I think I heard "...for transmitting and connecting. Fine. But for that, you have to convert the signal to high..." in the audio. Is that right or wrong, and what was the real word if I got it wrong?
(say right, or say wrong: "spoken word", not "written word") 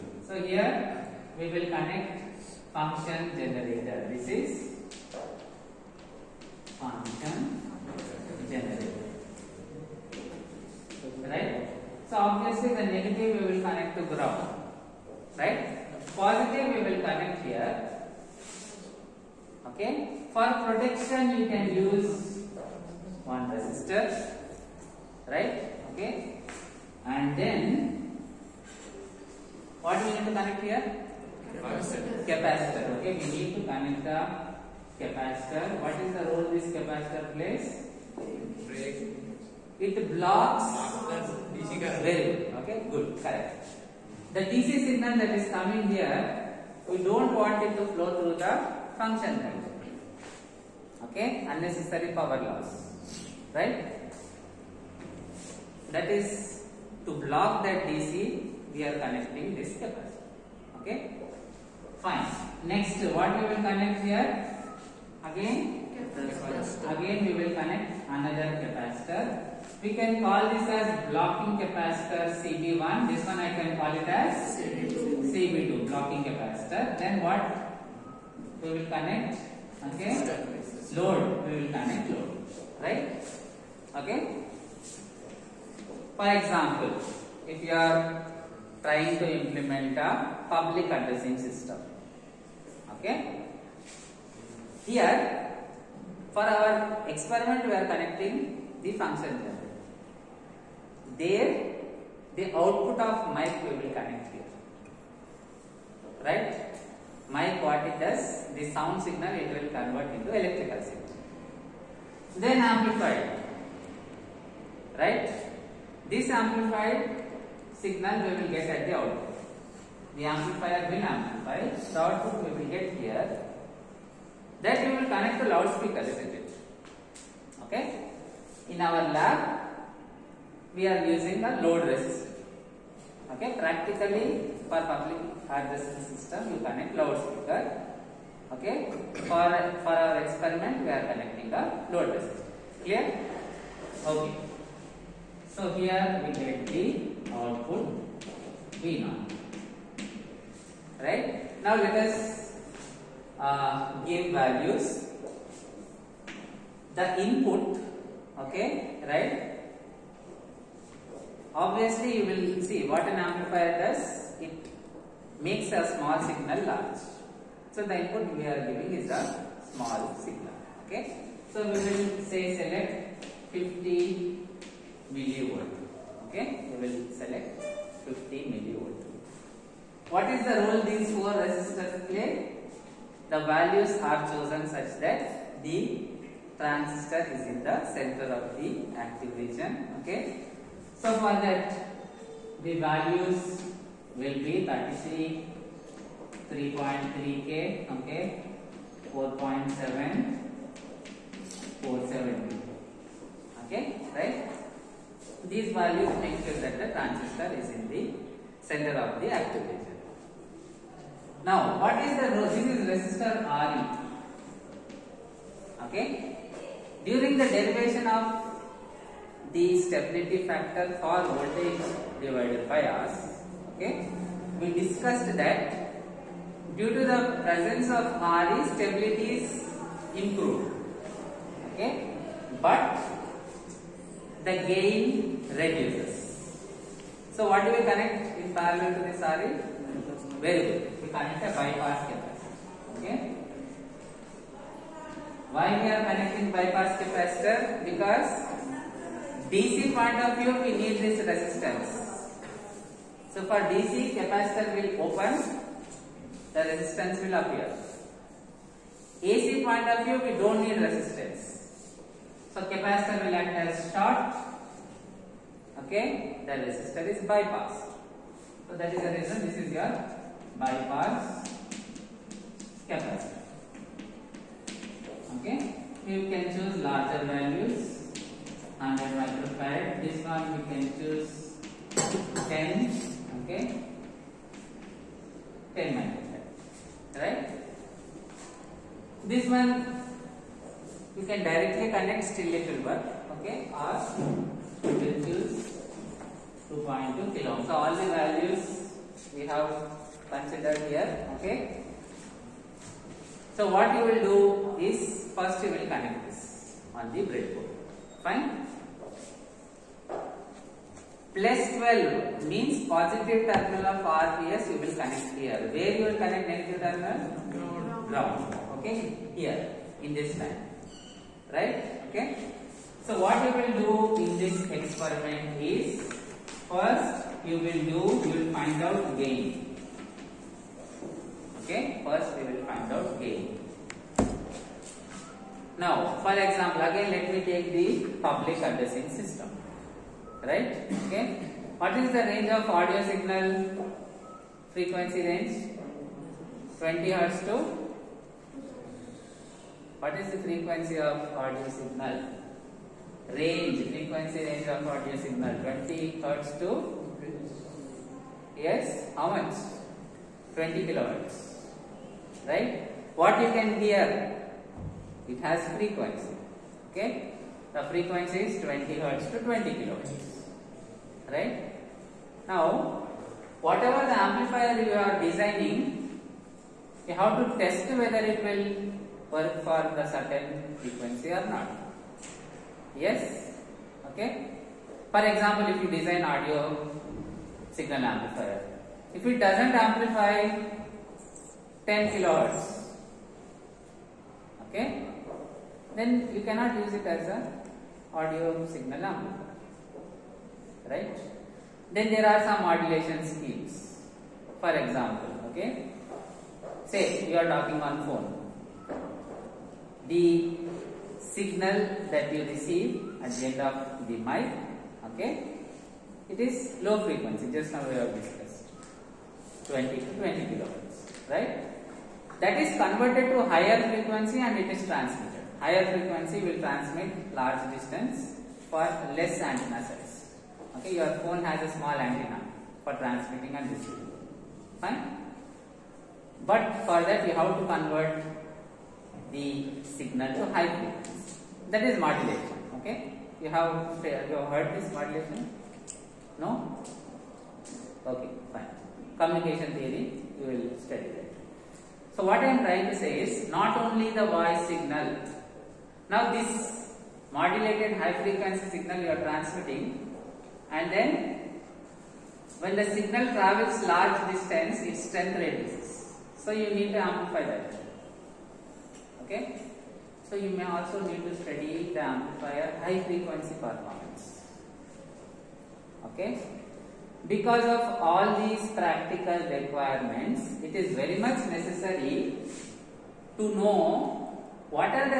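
wrong: "receiving", not "connecting".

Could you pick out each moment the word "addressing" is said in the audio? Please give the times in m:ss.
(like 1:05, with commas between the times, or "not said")
1:30, 5:38.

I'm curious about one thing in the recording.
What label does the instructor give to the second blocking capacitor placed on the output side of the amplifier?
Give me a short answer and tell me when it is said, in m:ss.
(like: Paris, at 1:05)
CB2, at 1:14.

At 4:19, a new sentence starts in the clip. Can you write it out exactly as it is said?
AC point of view, we don't need resistance.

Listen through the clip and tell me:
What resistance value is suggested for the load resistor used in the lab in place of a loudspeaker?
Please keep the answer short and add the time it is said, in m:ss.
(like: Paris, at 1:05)
2.2 kilo ohm, at 4:56.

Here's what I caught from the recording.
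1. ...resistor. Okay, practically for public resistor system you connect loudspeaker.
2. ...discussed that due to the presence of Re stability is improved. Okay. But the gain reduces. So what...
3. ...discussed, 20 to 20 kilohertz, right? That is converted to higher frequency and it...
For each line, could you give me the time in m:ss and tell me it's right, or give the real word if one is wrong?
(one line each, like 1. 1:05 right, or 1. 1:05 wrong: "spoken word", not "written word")
1. 2:11 right
2. 3:44 right
3. 6:58 right.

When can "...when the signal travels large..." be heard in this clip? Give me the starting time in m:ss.
7:42.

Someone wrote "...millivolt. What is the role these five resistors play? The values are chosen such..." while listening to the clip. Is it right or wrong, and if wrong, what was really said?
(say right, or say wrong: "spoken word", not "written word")
wrong: "four", not "five".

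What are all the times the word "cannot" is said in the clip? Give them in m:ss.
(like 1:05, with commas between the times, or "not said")
6:36.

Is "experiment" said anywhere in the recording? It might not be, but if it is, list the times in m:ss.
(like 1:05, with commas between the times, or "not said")
1:37, 2:20, 5:24.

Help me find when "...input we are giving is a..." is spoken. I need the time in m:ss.
2:48.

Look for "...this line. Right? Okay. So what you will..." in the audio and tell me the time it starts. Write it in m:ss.
5:20.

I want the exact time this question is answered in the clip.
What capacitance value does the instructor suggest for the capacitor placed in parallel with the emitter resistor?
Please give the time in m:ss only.
4:38.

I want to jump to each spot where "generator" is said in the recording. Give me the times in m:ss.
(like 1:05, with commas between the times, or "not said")
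0:03, 0:08.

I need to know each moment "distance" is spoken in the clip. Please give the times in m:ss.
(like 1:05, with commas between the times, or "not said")
7:07, 7:44.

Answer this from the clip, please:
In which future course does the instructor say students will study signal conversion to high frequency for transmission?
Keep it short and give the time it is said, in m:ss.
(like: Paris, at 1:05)
Communication theory, at 7:29.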